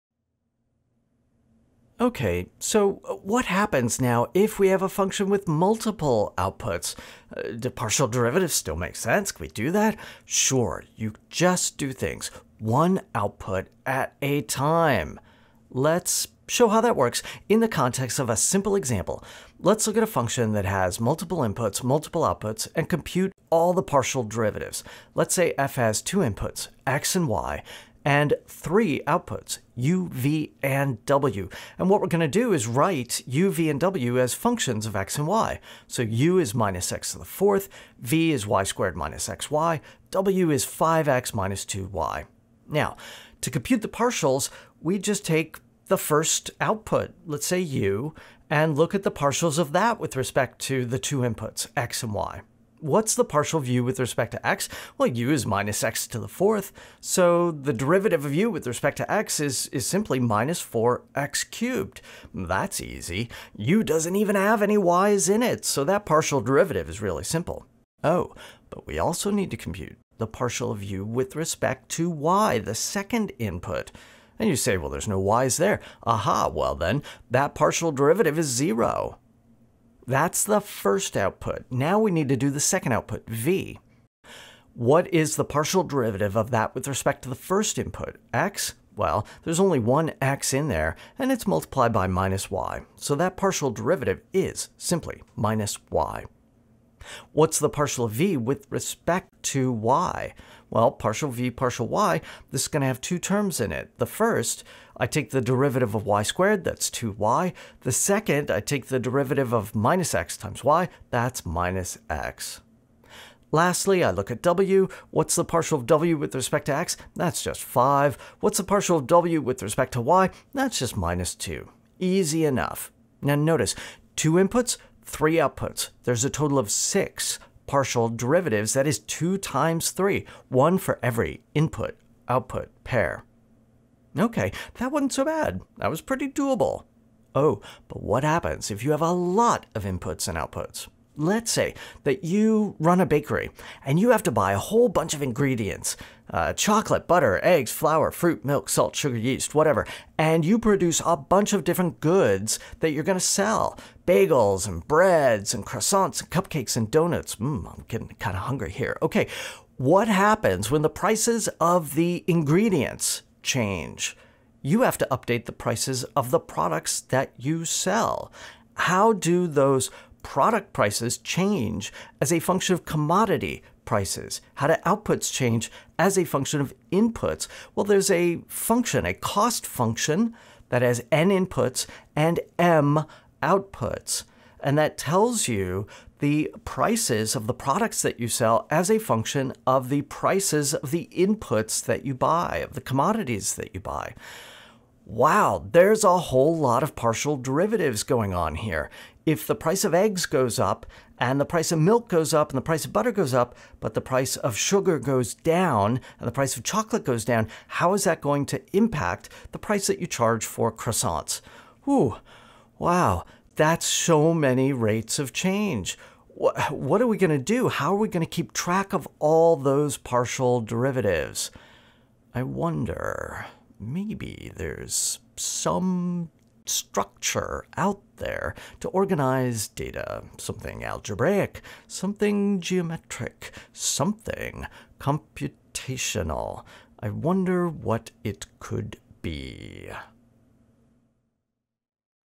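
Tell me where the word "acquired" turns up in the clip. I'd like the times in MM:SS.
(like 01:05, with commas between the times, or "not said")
not said.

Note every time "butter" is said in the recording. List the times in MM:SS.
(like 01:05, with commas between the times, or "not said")
02:27, 03:22.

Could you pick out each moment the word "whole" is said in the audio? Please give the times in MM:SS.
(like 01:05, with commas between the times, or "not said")
02:24, 03:16.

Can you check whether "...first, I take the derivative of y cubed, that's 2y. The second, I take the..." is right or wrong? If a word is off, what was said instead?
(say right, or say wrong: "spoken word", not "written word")
wrong: "squared", not "cubed".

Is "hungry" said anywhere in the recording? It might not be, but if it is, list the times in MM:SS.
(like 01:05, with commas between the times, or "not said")
02:38.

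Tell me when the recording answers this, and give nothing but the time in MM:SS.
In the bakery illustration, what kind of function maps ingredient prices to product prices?
02:59.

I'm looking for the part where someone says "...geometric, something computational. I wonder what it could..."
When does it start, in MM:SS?
03:52.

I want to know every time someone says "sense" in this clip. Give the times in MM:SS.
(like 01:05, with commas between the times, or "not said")
00:08.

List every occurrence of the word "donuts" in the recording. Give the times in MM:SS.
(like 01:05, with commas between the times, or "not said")
02:36.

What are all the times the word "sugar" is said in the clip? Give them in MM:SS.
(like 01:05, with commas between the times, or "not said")
02:28, 03:24.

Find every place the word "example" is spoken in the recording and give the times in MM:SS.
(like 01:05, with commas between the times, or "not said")
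00:18.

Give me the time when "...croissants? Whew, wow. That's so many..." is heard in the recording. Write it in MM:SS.
03:30.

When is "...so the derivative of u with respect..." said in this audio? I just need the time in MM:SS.
00:56.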